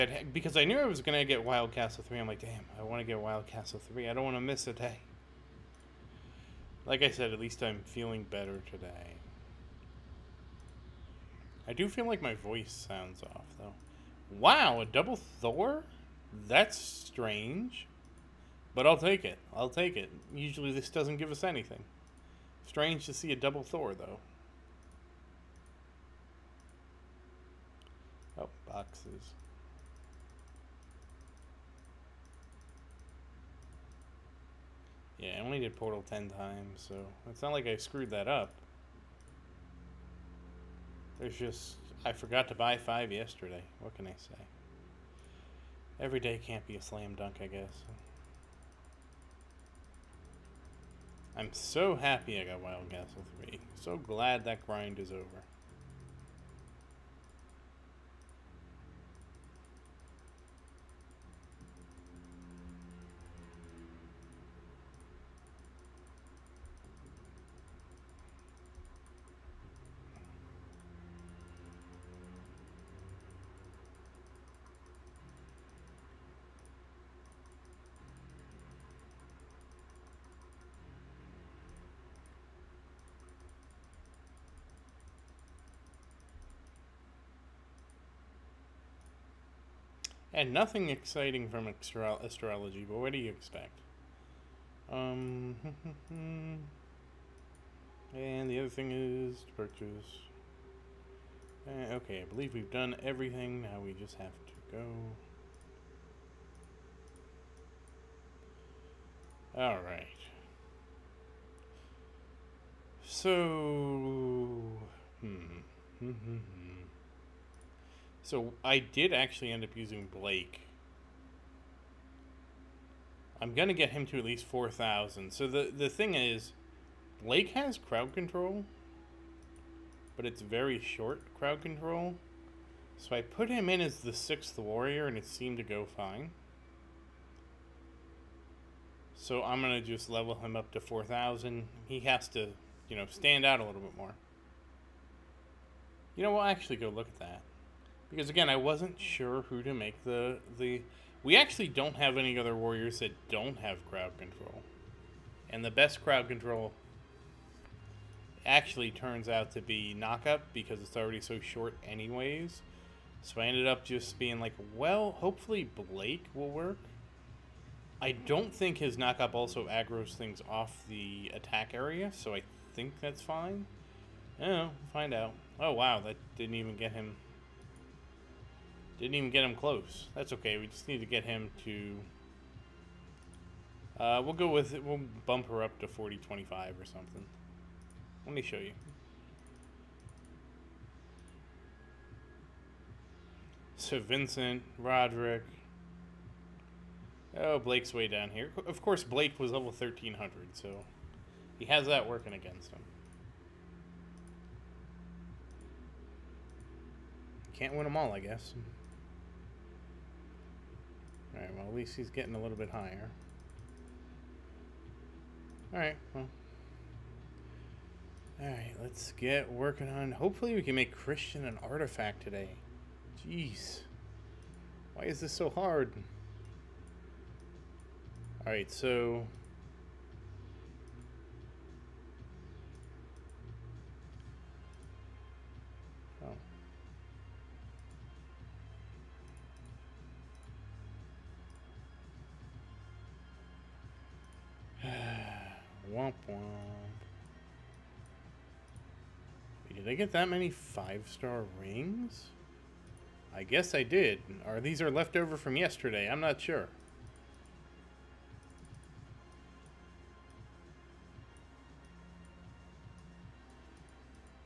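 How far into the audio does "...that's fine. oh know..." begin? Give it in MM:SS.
02:53.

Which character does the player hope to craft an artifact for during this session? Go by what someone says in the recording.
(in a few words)
Christian.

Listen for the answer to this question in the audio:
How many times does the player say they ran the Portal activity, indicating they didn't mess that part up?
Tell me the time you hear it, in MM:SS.
00:36.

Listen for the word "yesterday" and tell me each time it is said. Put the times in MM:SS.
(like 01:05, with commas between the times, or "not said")
00:43, 04:15.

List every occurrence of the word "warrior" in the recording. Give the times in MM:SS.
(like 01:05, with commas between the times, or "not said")
02:14, 02:32.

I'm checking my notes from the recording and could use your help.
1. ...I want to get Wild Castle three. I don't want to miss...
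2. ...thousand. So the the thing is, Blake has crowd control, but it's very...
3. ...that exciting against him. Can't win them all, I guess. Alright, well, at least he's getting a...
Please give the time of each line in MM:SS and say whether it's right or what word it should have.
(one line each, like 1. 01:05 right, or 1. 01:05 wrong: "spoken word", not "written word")
1. 00:02 right
2. 02:04 right
3. 03:21 wrong: "working", not "exciting".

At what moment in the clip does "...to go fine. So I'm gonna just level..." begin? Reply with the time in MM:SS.
02:15.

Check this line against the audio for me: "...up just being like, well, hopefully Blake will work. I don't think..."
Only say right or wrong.
right.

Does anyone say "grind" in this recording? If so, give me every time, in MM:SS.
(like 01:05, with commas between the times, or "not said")
00:54.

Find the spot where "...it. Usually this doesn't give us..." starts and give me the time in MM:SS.
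00:19.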